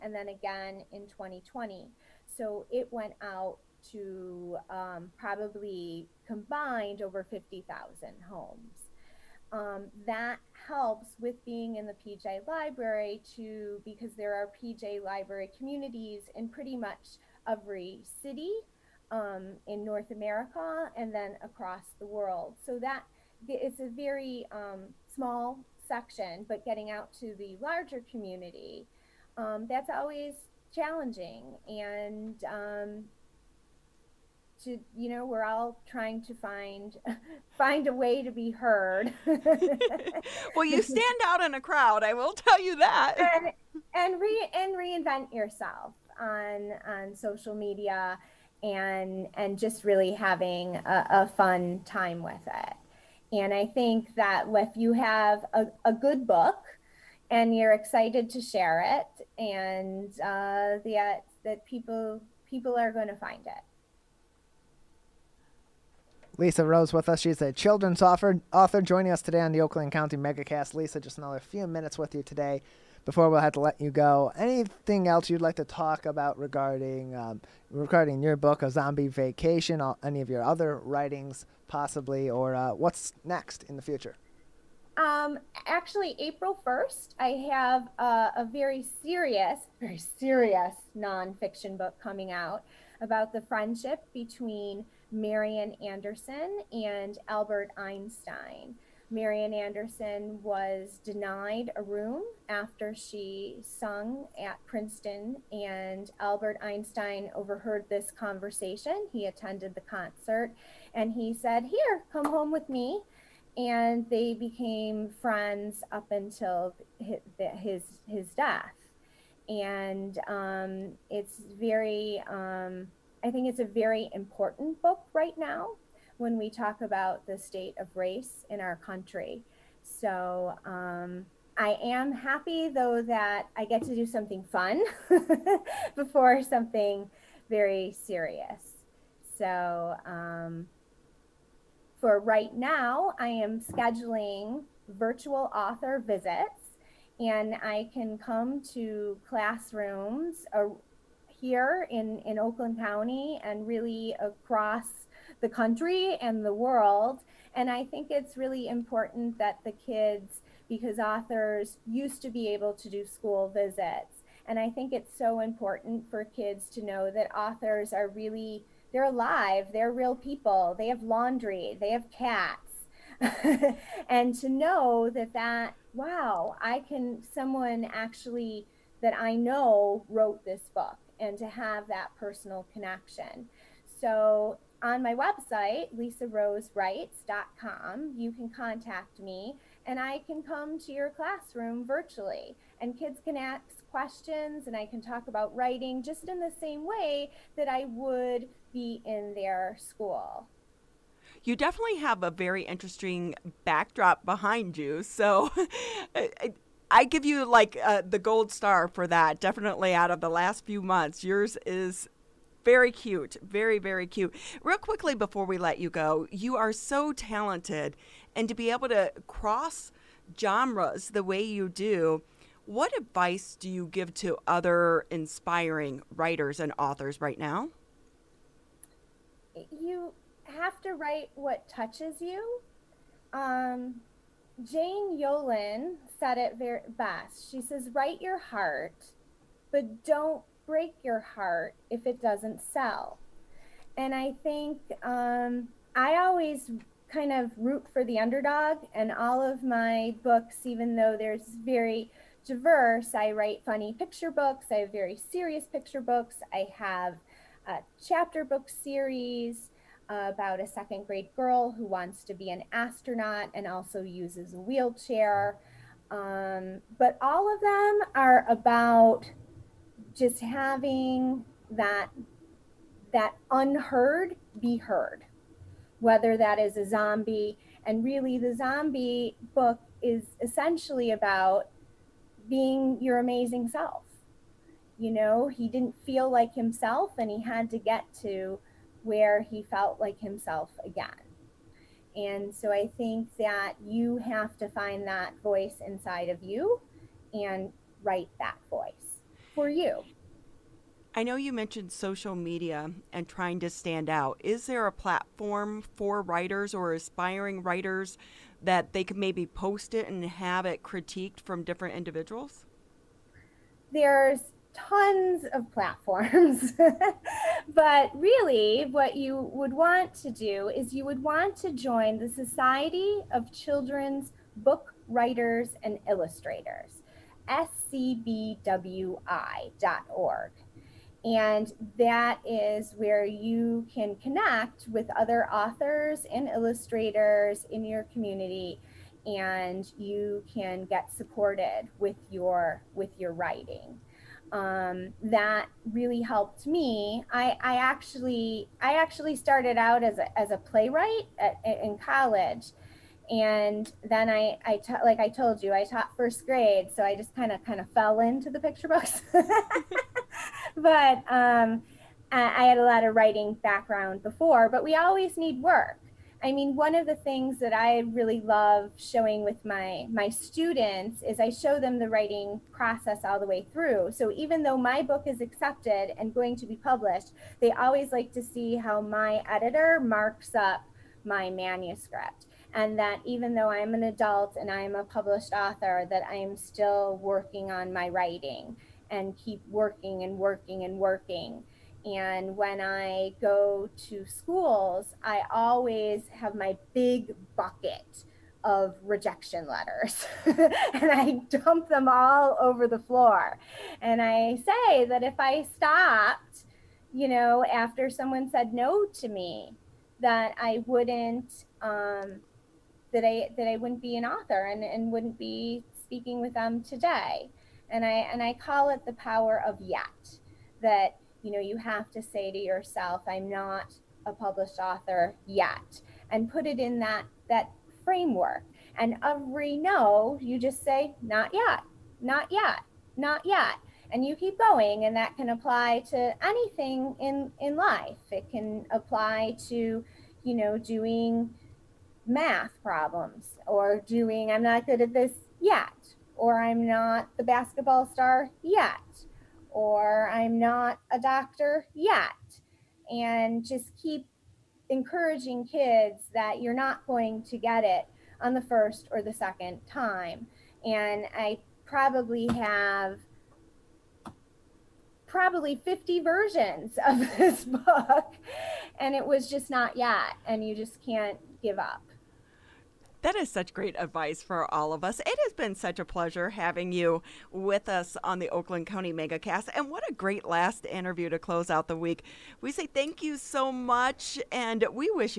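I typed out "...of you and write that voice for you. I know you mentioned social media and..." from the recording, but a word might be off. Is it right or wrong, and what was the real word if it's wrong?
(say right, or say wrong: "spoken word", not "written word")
right.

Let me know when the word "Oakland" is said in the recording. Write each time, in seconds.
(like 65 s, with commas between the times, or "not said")
69 s, 152 s, 478 s.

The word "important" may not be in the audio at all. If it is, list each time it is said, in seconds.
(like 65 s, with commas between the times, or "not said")
124 s, 158 s, 165 s.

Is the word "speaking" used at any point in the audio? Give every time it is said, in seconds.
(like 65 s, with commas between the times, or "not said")
416 s.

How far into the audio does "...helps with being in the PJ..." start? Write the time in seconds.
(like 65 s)
10 s.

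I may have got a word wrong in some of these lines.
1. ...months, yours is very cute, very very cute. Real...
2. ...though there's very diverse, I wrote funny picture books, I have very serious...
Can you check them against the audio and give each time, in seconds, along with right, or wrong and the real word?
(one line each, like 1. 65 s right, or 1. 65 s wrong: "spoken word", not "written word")
1. 210 s right
2. 250 s wrong: "write", not "wrote".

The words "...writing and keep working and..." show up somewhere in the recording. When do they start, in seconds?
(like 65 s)
388 s.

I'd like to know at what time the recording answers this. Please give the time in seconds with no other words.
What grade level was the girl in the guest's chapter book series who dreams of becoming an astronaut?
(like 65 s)
260 s.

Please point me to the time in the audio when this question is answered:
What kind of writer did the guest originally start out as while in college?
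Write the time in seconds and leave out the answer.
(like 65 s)
350 s.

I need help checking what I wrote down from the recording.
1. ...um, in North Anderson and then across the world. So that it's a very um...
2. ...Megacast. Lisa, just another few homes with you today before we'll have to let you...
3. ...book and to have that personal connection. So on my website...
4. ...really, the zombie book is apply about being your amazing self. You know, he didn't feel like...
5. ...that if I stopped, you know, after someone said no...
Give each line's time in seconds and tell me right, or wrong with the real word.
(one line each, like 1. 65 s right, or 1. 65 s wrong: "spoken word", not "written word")
1. 19 s wrong: "America", not "Anderson"
2. 70 s wrong: "minutes", not "homes"
3. 180 s right
4. 278 s wrong: "essentially", not "apply"
5. 405 s right.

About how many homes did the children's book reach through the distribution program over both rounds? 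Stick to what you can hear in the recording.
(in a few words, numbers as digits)
50,000.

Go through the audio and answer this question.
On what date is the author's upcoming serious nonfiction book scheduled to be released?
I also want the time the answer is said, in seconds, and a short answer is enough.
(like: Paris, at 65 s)
April 1st, at 86 s.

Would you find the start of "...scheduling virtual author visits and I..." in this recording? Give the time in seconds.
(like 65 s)
143 s.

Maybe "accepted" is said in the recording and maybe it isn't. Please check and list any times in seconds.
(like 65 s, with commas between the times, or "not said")
375 s.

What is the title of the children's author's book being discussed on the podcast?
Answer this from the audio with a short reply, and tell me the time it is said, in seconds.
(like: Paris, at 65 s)
A Zombie Vacation, at 78 s.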